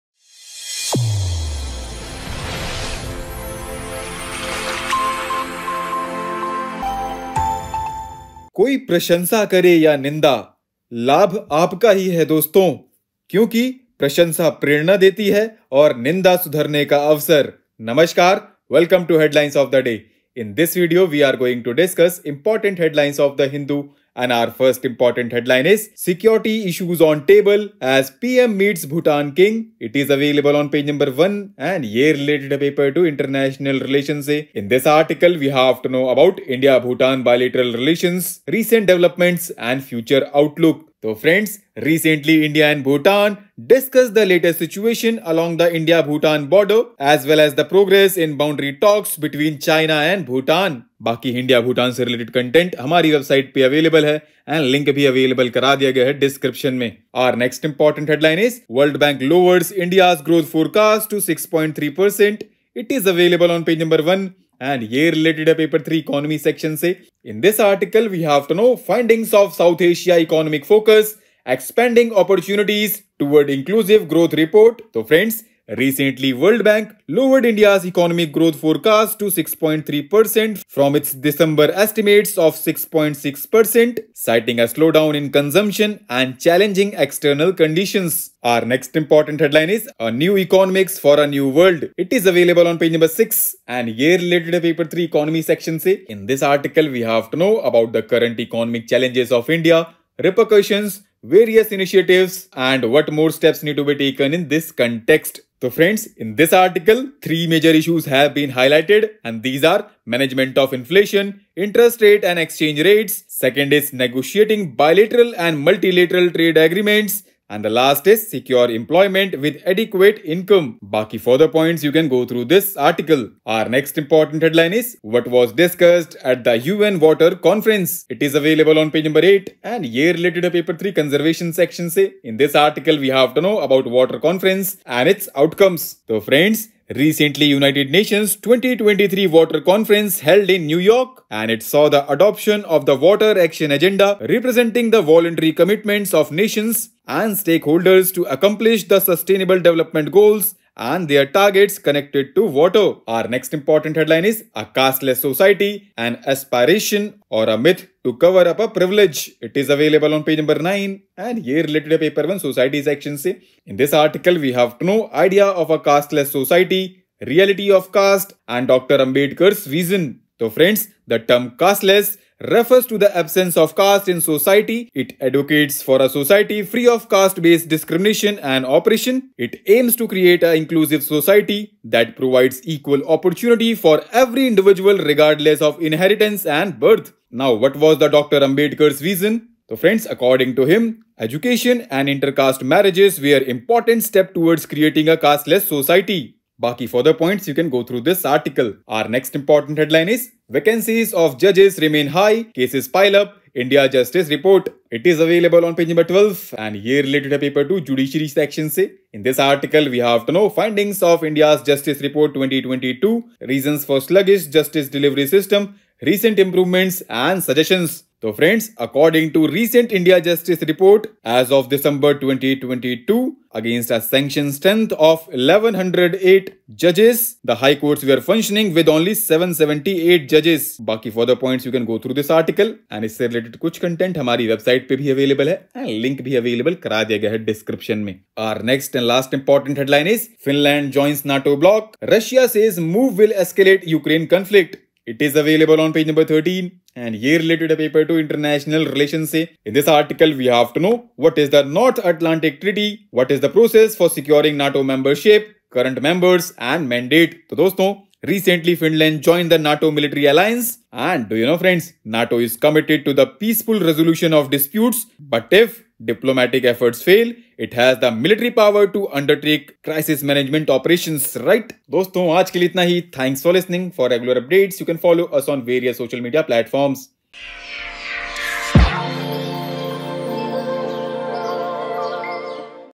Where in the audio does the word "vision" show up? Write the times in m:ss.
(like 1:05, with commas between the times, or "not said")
2:49, 3:08.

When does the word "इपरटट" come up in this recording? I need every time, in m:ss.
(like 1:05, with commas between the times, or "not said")
0:22, 0:57.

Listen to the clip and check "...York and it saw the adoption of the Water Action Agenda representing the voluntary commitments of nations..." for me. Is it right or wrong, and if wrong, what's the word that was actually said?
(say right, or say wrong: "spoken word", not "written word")
right.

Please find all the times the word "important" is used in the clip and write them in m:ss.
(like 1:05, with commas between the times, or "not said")
0:24, 1:28, 2:03, 2:33, 3:13, 3:19, 3:59.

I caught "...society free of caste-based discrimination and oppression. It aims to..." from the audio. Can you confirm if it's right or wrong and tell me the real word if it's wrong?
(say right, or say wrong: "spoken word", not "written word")
right.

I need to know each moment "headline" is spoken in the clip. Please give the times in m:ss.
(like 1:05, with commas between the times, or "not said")
0:25, 1:29, 2:04, 2:33, 3:19, 3:59.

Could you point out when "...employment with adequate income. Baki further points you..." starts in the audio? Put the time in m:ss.
1:58.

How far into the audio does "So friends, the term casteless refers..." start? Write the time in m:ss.
2:50.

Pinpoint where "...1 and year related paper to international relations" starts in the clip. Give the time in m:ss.
0:31.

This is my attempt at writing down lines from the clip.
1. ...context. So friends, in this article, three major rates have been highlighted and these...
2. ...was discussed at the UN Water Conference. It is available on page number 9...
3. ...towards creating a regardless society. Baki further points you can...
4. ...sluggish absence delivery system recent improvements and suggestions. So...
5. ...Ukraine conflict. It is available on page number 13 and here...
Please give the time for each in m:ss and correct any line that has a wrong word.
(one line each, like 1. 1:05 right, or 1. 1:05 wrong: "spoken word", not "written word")
1. 1:44 wrong: "issues", not "rates"
2. 2:05 wrong: "8", not "9"
3. 3:14 wrong: "casteless", not "regardless"
4. 3:34 wrong: "justice", not "absence"
5. 4:03 right.